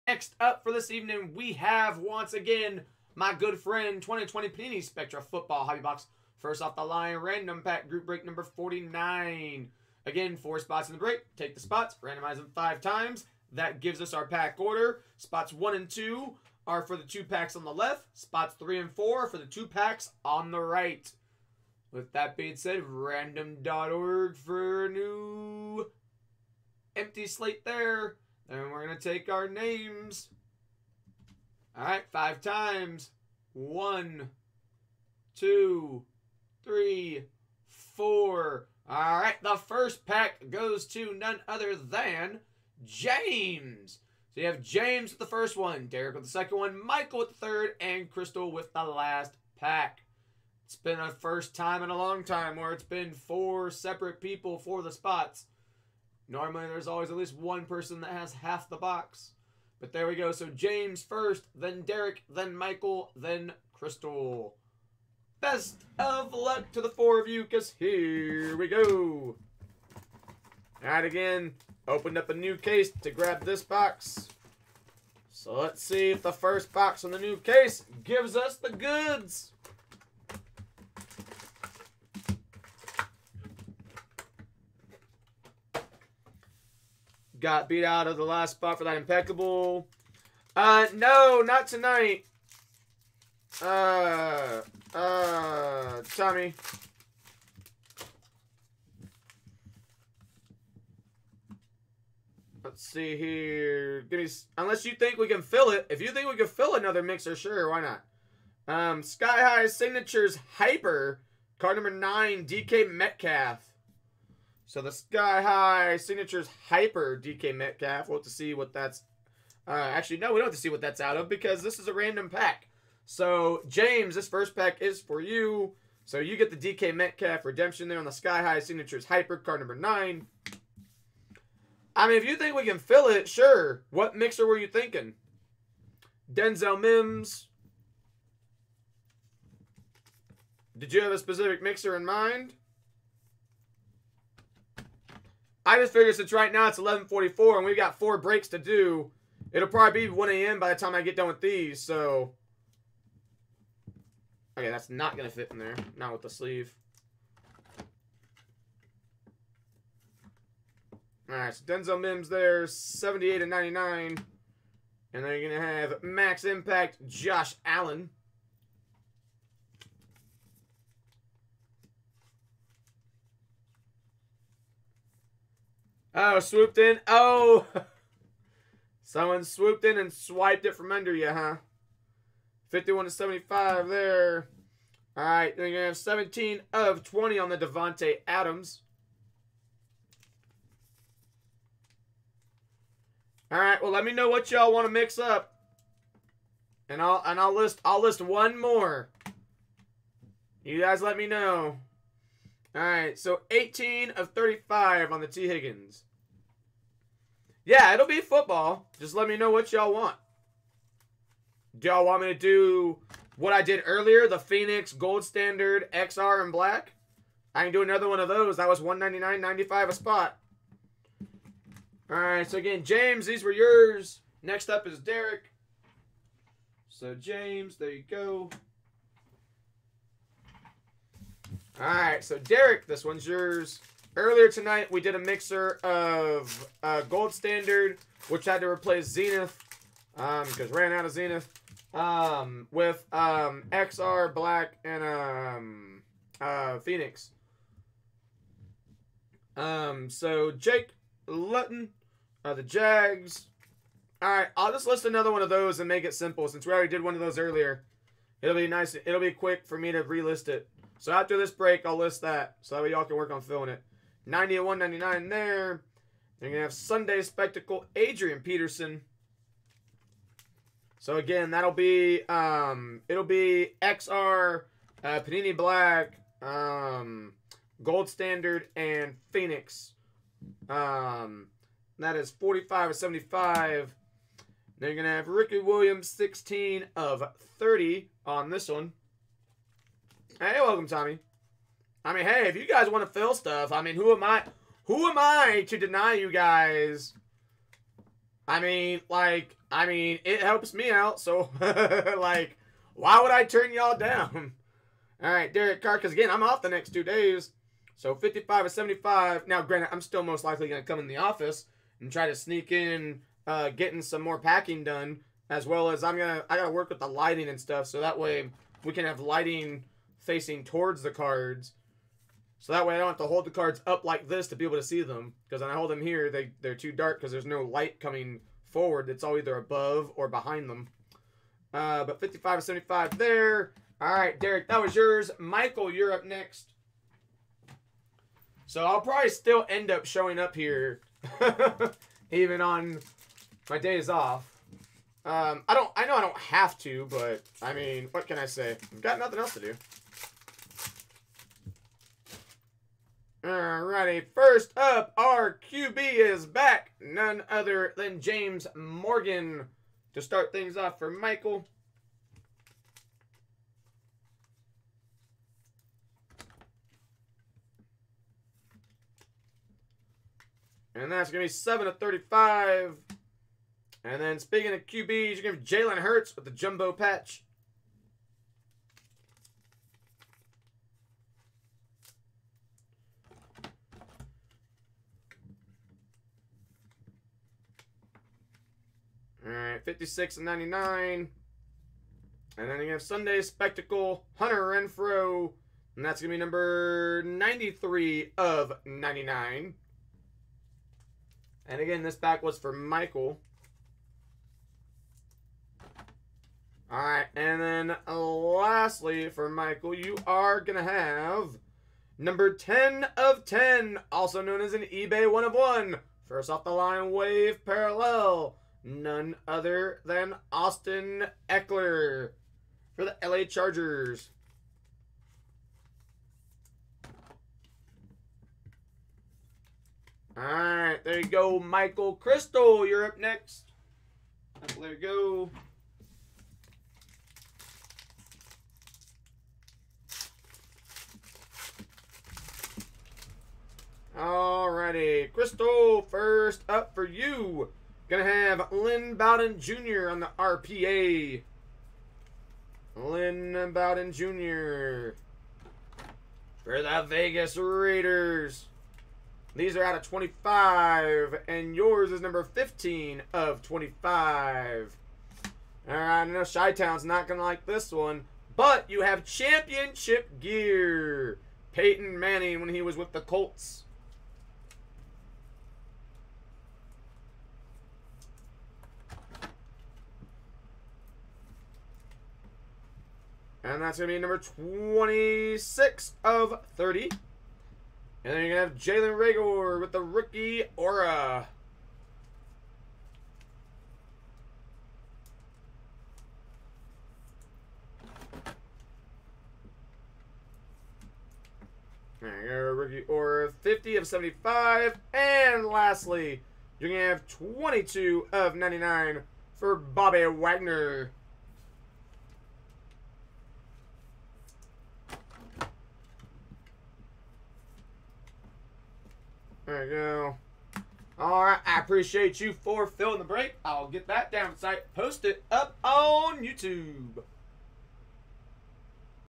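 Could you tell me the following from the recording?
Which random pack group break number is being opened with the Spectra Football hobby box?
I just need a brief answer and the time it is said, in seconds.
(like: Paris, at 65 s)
49, at 8 s.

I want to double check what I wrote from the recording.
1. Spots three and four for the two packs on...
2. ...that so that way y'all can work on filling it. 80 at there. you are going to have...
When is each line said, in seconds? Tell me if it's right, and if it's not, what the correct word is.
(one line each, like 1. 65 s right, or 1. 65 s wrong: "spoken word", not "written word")
1. 18 s right
2. 262 s wrong: "90", not "80".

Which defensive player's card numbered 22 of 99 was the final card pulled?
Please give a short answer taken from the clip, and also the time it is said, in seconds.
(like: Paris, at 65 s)
Bobby Wagner, at 509 s.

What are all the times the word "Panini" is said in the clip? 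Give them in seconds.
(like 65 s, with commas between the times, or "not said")
4 s, 275 s.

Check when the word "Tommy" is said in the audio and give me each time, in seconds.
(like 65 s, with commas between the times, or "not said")
96 s, 290 s.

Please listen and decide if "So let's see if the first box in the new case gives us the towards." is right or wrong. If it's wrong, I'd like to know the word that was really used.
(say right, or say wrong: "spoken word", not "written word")
wrong: "goods", not "towards".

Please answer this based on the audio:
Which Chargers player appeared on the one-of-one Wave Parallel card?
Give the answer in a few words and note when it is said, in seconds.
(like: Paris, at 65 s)
Austin Ekeler, at 420 s.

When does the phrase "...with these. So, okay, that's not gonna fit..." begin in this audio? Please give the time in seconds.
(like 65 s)
151 s.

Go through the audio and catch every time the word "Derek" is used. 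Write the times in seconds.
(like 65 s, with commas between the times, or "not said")
45 s, 61 s, 224 s, 232 s, 305 s, 334 s.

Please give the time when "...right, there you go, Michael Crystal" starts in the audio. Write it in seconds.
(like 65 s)
430 s.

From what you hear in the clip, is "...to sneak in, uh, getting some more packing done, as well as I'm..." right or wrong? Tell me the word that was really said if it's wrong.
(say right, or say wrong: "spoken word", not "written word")
right.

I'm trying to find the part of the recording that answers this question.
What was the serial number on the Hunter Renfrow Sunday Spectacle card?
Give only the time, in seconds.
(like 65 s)
397 s.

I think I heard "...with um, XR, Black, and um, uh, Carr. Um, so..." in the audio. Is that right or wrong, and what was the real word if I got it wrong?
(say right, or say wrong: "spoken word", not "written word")
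wrong: "Phoenix", not "Carr".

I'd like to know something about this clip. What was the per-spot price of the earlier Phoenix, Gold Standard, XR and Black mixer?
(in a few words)
$199.95.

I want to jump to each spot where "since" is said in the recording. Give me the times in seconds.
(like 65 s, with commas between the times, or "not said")
146 s, 256 s.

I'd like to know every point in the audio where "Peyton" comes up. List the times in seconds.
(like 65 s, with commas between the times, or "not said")
471 s.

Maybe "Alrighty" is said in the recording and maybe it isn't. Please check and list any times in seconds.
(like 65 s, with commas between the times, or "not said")
353 s, 444 s.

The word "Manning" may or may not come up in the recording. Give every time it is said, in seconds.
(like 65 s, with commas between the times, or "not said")
472 s.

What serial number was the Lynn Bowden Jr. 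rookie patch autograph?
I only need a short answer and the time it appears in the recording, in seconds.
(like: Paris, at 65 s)
15 of 25, at 462 s.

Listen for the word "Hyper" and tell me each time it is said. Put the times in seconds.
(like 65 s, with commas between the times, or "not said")
110 s, 116 s, 129 s.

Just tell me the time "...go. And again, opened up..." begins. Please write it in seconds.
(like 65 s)
68 s.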